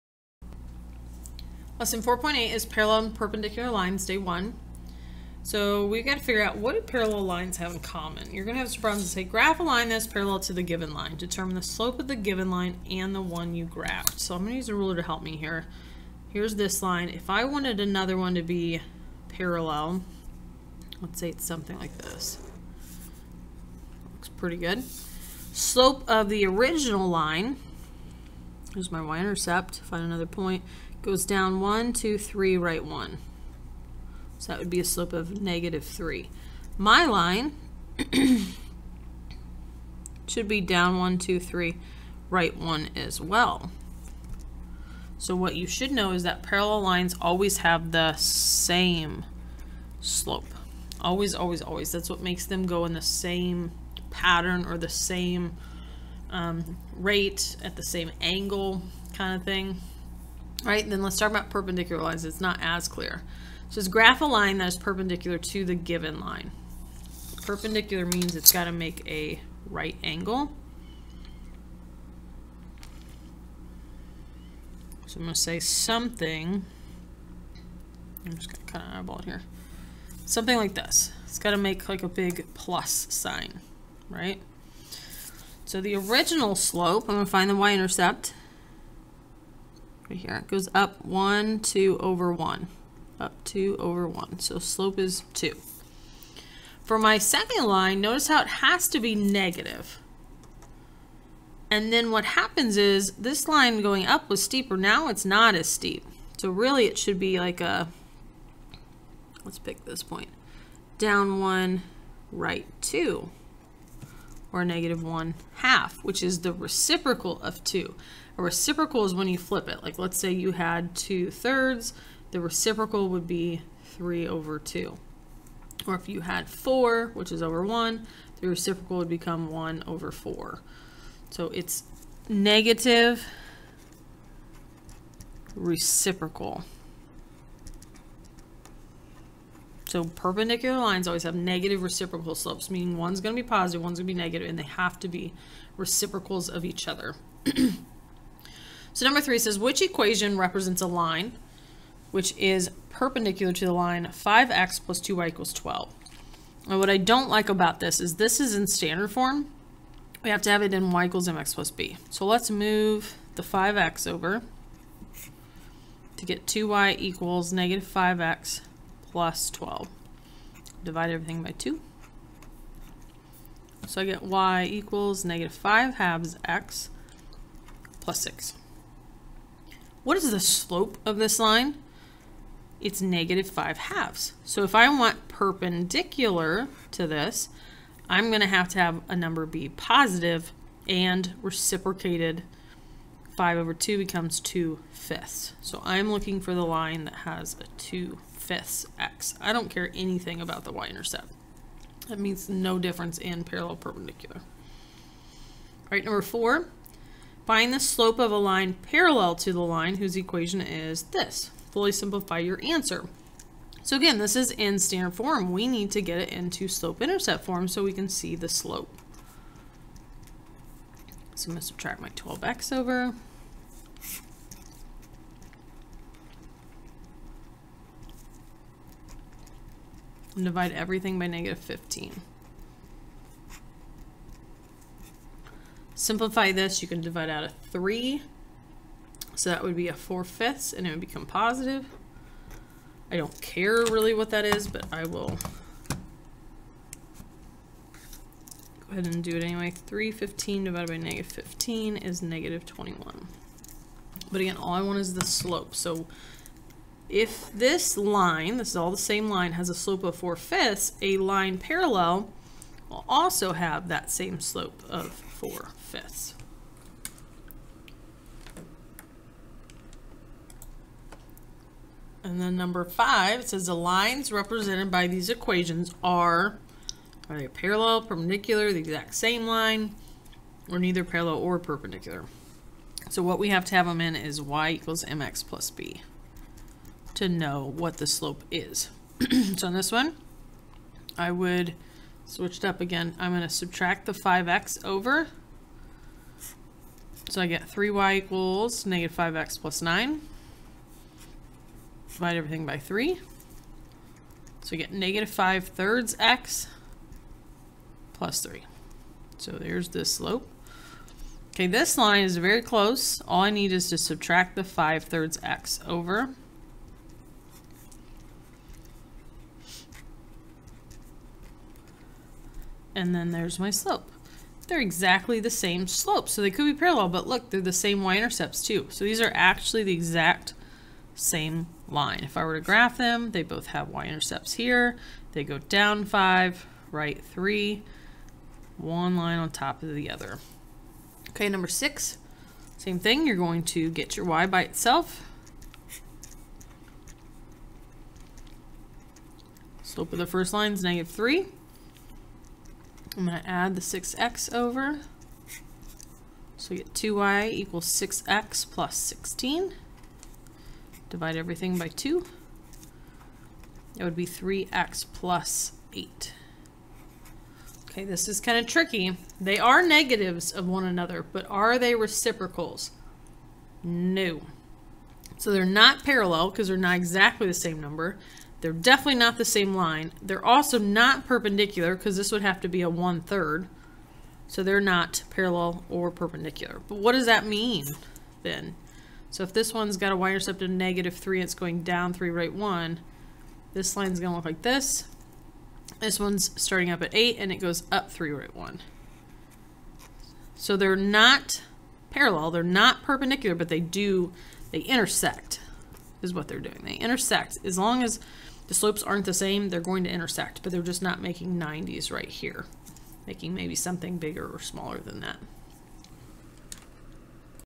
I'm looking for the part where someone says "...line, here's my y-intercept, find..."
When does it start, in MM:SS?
00:27.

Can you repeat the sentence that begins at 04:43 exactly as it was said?
So what we have to have them in is y equals mx plus b to know what the slope is.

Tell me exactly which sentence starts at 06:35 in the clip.
This one's starting up at 8 and it goes up 3 root 1.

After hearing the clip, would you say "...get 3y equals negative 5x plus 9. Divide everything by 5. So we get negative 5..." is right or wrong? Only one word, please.
wrong.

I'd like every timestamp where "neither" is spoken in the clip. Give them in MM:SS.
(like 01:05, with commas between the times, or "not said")
04:40.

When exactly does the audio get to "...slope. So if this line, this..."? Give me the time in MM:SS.
04:15.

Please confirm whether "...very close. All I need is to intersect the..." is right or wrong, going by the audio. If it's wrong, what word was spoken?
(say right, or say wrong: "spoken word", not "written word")
wrong: "subtract", not "intersect".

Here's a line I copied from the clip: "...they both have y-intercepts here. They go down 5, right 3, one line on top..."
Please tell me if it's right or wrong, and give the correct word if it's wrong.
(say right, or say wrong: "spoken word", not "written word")
right.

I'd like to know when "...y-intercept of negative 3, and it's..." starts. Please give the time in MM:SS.
06:30.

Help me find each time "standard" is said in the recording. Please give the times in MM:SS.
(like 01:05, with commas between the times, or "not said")
02:38, 03:34.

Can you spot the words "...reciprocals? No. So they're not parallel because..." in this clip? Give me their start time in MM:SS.
06:11.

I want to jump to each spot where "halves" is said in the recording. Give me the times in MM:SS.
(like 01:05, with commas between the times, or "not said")
02:55, 03:03.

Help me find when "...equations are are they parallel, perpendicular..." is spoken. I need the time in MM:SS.
04:35.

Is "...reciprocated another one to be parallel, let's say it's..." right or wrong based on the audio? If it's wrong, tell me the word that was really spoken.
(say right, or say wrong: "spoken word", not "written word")
wrong: "wanted", not "reciprocated".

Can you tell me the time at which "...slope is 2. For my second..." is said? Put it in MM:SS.
01:34.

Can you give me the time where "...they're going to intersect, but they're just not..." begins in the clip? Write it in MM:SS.
06:49.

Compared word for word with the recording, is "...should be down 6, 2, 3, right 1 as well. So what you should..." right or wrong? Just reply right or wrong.
wrong.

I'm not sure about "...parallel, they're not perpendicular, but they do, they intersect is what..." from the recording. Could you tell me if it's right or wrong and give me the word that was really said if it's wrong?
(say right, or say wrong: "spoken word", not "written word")
right.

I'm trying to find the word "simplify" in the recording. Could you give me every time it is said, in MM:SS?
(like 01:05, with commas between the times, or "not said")
03:31, 03:55.